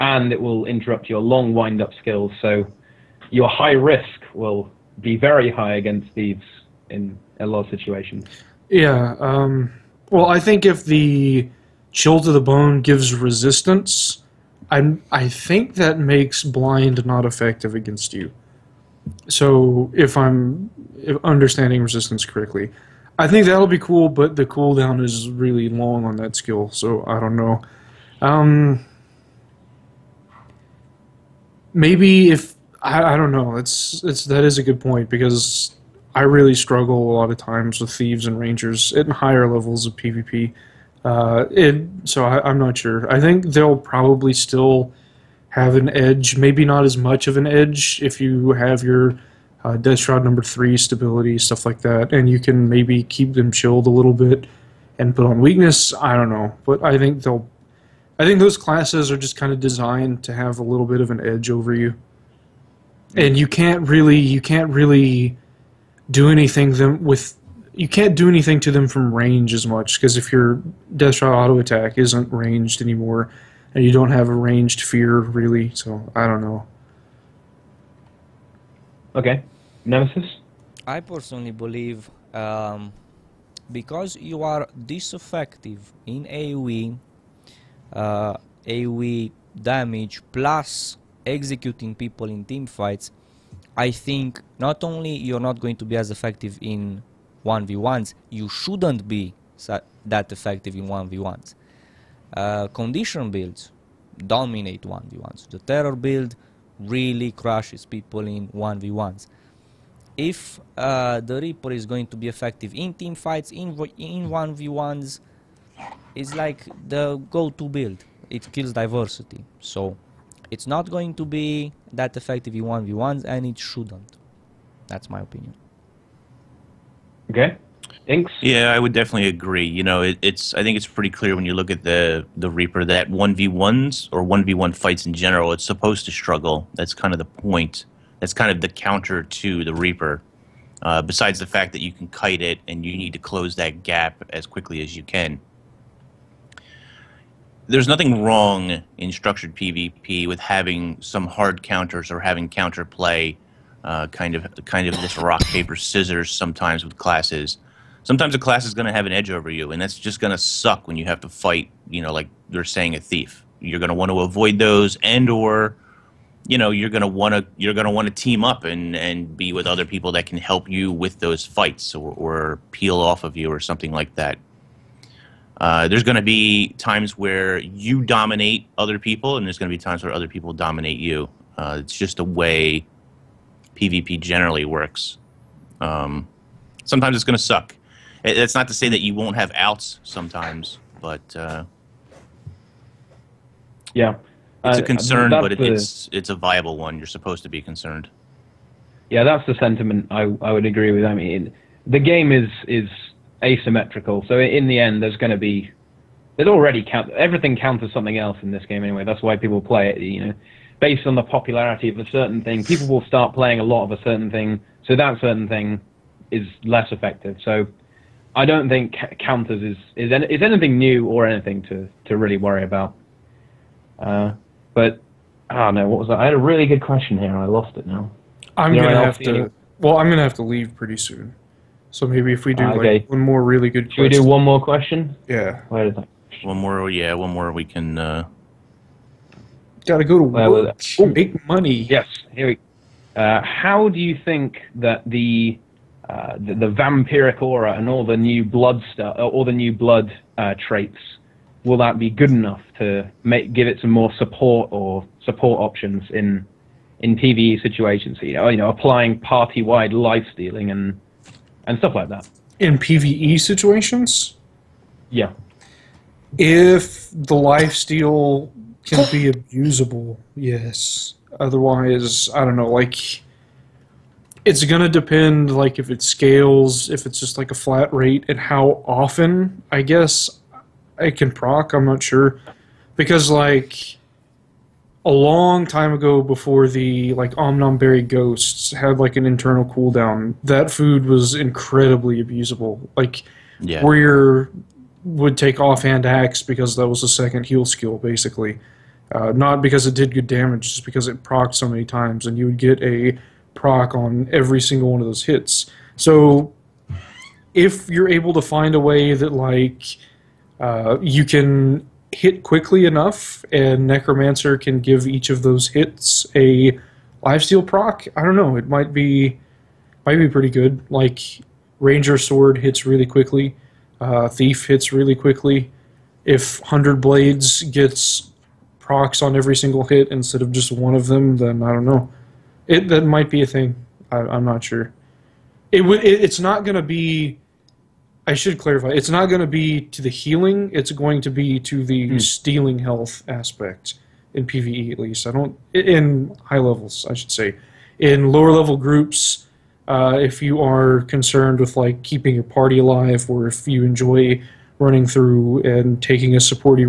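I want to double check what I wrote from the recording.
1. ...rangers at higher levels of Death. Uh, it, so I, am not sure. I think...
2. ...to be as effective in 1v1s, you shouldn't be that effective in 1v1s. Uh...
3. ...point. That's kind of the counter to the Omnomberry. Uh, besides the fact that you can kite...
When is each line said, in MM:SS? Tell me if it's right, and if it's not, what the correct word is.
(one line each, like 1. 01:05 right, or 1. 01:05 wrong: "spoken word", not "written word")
1. 00:38 wrong: "PvP", not "Death"
2. 01:35 right
3. 02:17 wrong: "Reaper", not "Omnomberry".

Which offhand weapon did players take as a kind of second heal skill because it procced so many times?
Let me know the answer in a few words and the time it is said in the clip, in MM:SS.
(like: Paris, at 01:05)
Axe, at 04:55.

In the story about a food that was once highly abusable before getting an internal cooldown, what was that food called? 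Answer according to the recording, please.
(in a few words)
Omnomberry Ghosts.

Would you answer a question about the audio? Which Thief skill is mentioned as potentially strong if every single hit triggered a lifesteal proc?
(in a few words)
100 Blades.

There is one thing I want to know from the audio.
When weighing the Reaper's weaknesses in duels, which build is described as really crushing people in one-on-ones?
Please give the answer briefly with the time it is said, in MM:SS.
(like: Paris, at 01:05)
Terror build, at 01:45.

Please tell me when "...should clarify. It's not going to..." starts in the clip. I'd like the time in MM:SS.
05:38.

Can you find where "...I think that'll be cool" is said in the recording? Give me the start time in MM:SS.
00:23.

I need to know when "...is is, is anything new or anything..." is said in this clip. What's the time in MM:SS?
03:39.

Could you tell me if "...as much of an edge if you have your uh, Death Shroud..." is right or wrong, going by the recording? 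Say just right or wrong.
right.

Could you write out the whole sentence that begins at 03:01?
Uh, it's just a way PvP generally works.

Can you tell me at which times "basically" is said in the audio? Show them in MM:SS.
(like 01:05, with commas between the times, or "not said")
04:57.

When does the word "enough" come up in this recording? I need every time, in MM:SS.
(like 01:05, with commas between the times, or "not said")
04:12, 05:12.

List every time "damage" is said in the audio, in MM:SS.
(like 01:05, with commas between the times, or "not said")
01:29, 05:00.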